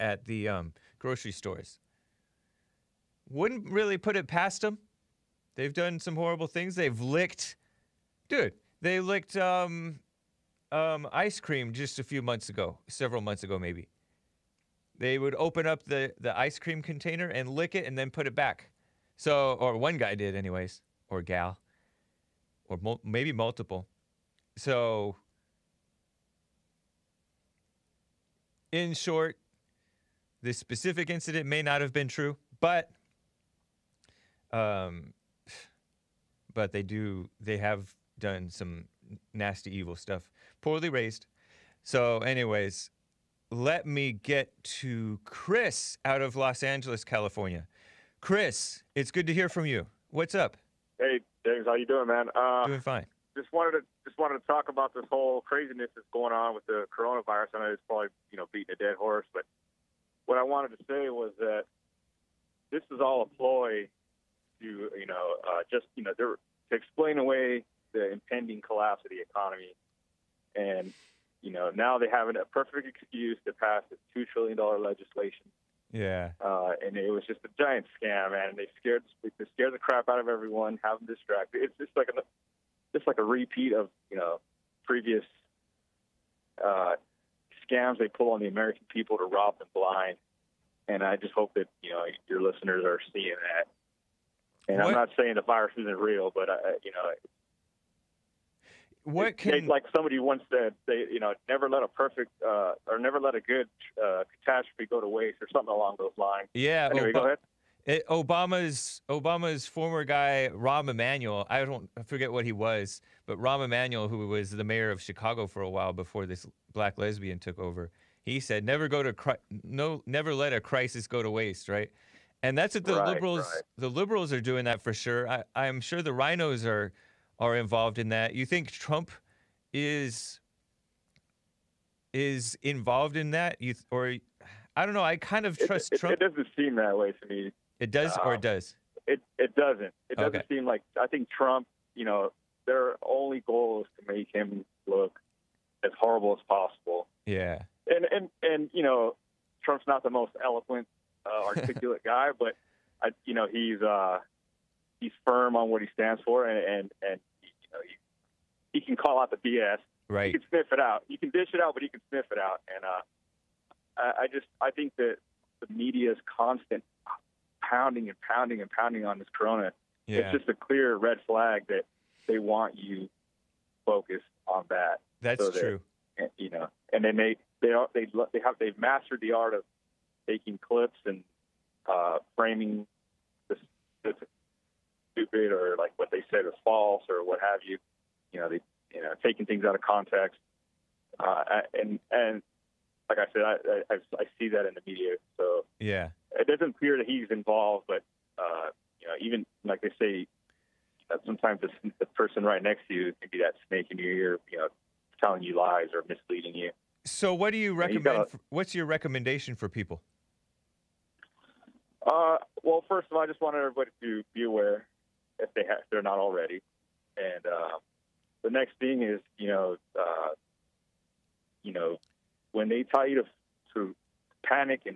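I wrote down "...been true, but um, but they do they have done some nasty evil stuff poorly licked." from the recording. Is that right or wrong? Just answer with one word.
wrong.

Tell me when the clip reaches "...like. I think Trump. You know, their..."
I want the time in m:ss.
2:20.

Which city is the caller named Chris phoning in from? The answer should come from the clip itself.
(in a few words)
Los Angeles.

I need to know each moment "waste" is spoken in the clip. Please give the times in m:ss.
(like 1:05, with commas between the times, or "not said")
1:45, 2:01.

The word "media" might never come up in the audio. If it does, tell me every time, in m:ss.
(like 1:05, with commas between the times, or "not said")
2:45, 3:14.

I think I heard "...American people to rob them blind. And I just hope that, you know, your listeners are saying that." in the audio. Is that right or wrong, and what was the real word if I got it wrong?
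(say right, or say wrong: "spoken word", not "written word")
wrong: "seeing", not "saying".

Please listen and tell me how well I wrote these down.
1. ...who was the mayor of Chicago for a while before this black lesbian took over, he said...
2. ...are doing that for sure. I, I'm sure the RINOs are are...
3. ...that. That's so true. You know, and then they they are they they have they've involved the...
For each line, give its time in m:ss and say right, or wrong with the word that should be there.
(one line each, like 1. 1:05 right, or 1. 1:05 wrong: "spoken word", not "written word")
1. 1:54 right
2. 2:04 right
3. 2:54 wrong: "mastered", not "involved".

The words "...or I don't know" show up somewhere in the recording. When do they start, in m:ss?
2:13.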